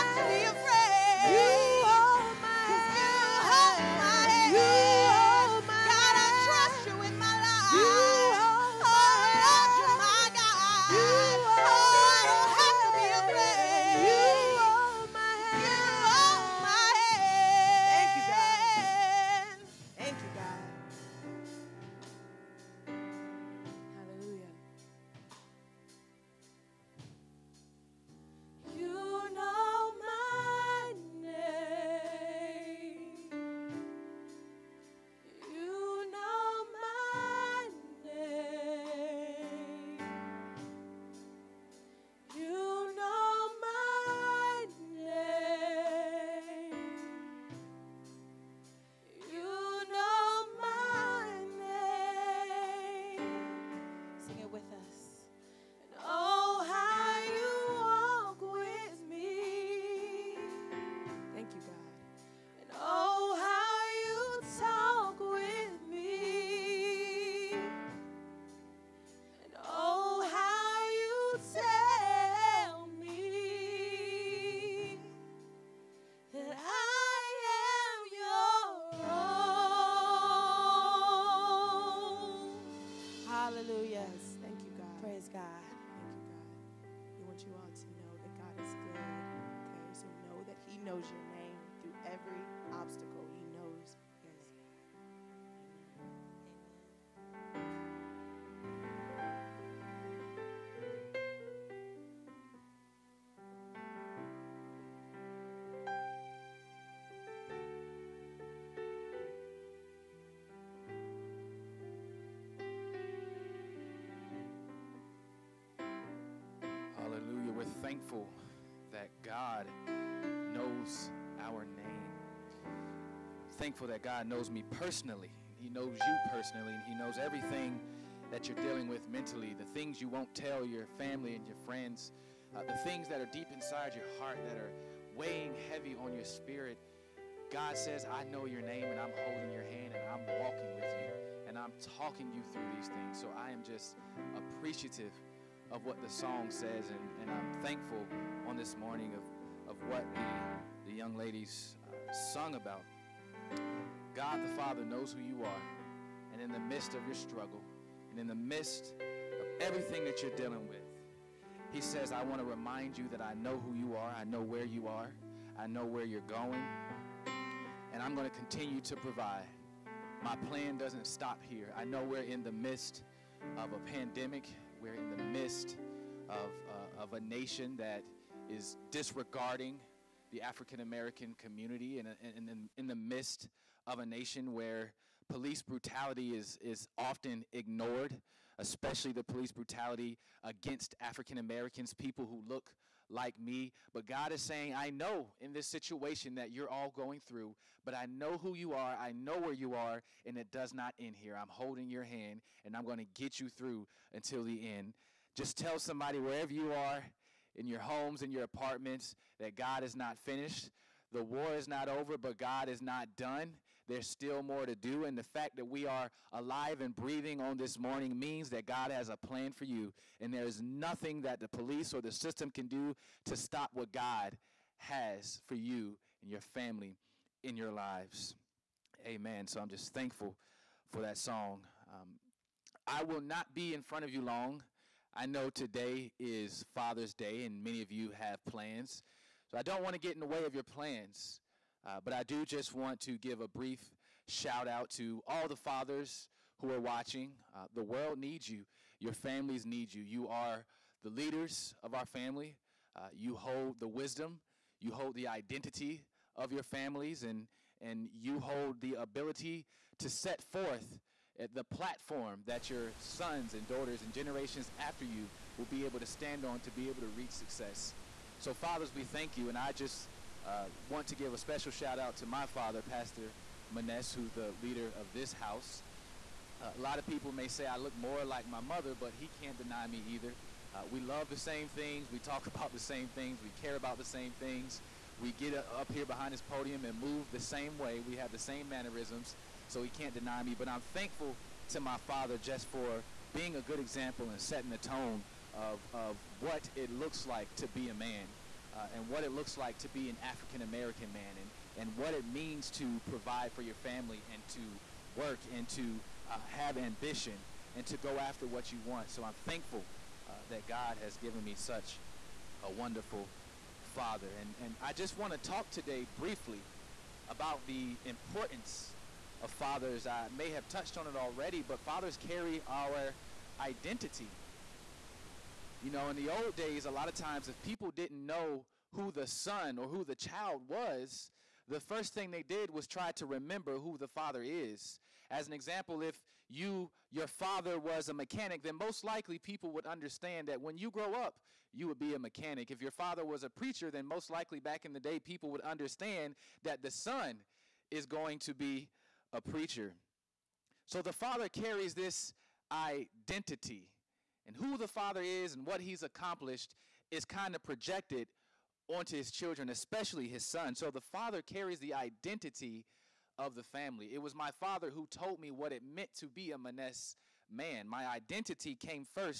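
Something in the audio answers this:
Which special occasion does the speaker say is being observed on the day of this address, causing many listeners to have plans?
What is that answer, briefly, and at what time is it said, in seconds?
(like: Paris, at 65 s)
Father's Day, at 236 s.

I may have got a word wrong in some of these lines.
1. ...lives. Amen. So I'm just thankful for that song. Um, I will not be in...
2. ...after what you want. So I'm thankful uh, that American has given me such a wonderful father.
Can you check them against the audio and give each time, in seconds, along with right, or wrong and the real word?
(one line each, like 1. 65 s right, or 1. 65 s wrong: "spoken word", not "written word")
1. 227 s right
2. 308 s wrong: "God", not "American".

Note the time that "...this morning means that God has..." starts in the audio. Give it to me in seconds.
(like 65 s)
217 s.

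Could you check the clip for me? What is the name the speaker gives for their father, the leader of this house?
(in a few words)
Pastor Maness.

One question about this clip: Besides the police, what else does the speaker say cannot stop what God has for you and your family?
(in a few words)
the system.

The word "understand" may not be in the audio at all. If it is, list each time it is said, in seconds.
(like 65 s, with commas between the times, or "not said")
339 s, 345 s.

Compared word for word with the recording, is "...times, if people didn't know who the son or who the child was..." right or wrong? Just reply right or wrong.
right.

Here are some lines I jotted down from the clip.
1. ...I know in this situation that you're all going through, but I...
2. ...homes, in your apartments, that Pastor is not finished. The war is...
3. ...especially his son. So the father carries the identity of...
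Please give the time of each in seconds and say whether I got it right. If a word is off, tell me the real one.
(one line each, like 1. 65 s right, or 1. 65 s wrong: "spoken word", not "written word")
1. 194 s right
2. 207 s wrong: "God", not "Pastor"
3. 359 s right.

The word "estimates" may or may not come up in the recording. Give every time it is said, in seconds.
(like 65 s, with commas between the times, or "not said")
not said.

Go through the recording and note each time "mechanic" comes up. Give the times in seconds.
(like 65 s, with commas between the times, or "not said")
338 s, 342 s.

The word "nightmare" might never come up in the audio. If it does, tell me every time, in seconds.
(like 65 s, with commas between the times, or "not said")
not said.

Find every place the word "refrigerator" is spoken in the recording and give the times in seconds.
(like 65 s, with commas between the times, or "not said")
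not said.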